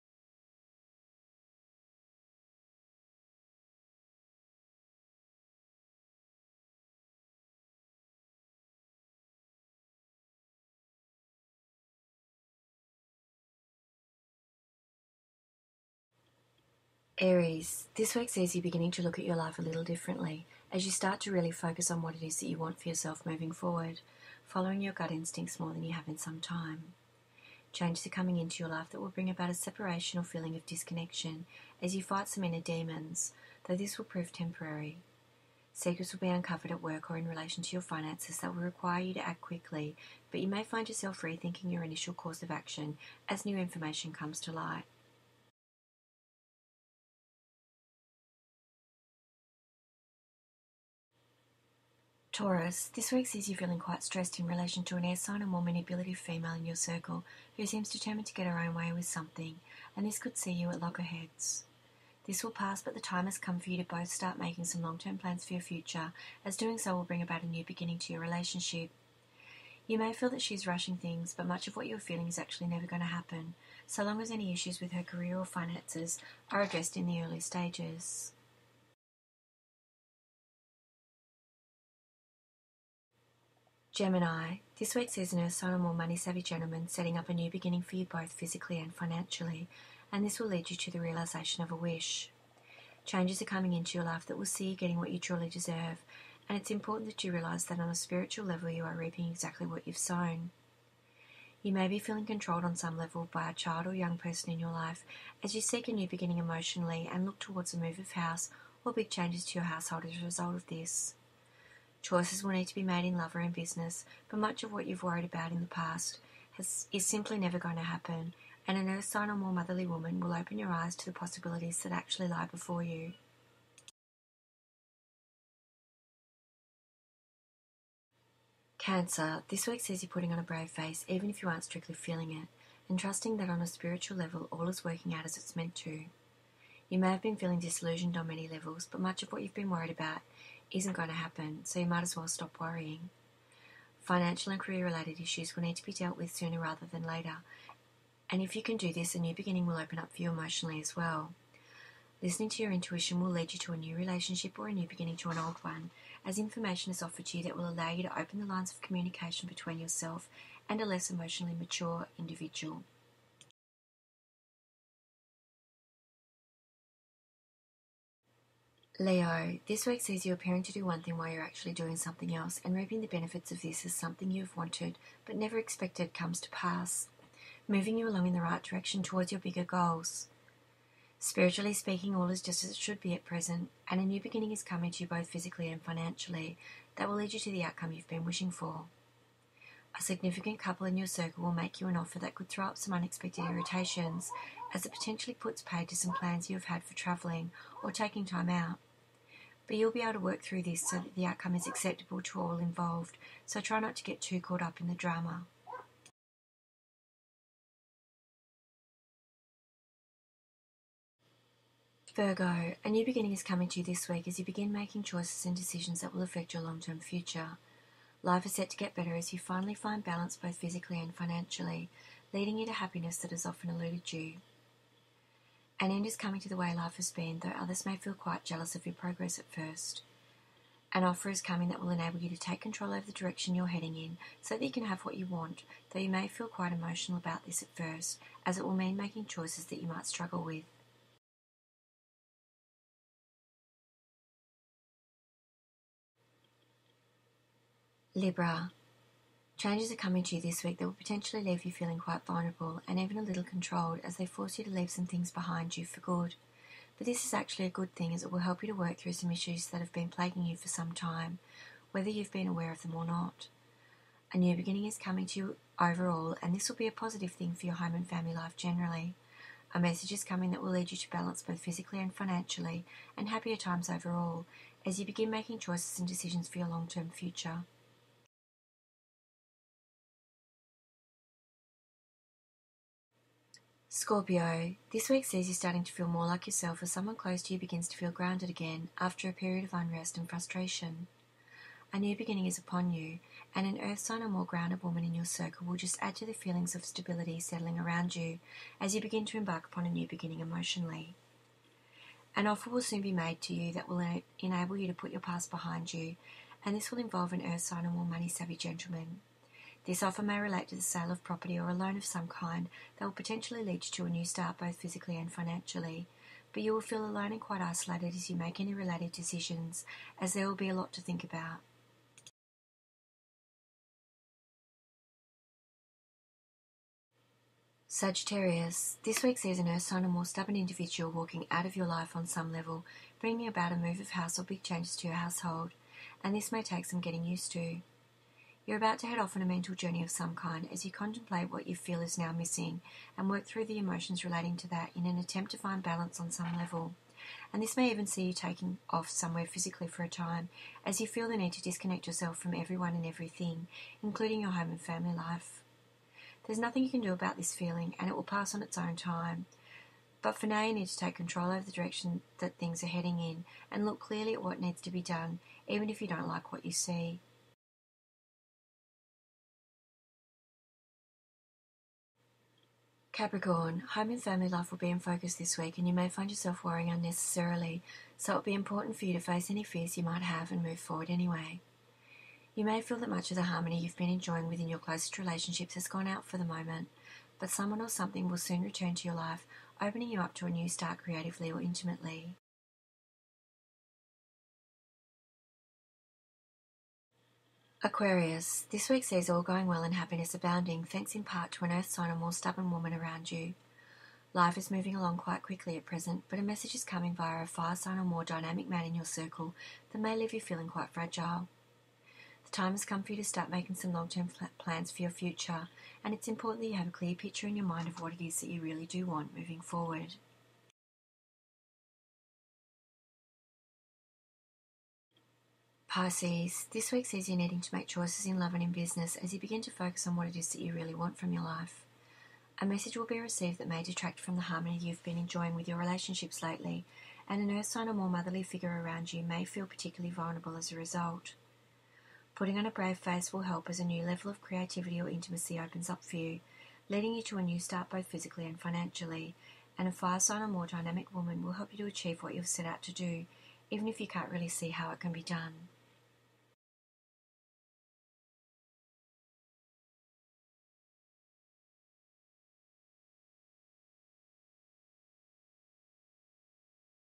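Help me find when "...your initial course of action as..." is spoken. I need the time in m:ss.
0:41.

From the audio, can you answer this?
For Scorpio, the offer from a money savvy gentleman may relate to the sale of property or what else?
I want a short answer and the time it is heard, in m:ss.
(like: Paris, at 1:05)
a loan, at 5:11.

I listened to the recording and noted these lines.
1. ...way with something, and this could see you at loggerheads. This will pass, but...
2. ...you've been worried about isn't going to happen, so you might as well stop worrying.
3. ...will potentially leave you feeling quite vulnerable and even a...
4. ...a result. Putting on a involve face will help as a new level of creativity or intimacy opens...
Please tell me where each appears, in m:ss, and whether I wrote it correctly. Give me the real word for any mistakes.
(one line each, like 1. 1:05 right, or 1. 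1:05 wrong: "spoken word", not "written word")
1. 0:58 right
2. 2:19 right
3. 4:10 right
4. 7:20 wrong: "brave", not "involve".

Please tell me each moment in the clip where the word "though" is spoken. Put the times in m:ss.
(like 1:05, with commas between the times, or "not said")
0:33, 3:47, 3:55.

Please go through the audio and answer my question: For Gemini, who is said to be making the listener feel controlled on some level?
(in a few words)
a child or young person.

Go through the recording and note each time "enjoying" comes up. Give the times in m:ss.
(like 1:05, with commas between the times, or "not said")
6:24, 7:15.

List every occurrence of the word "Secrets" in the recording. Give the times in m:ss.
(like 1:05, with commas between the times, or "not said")
0:35.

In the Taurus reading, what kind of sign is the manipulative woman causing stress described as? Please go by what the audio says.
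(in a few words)
air sign.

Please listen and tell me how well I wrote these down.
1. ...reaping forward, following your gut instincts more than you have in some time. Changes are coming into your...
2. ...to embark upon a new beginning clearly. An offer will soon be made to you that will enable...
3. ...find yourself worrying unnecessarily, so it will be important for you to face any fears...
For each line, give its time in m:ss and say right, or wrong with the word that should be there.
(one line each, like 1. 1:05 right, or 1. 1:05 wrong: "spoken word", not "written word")
1. 0:23 wrong: "moving", not "reaping"
2. 4:59 wrong: "emotionally", not "clearly"
3. 6:16 right.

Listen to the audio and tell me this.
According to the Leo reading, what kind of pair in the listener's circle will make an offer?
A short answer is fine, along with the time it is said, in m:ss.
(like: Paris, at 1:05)
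a significant couple, at 3:09.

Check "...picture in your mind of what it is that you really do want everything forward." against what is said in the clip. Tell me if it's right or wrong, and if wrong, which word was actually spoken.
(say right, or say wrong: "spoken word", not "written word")
wrong: "moving", not "everything".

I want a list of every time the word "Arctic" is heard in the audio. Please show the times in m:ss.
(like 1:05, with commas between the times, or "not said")
not said.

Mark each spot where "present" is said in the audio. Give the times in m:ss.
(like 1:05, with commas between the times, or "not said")
3:03, 6:45.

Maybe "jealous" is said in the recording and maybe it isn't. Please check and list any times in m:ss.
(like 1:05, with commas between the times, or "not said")
3:48.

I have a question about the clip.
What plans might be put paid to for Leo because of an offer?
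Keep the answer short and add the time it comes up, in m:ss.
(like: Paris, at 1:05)
travelling or taking time out, at 3:16.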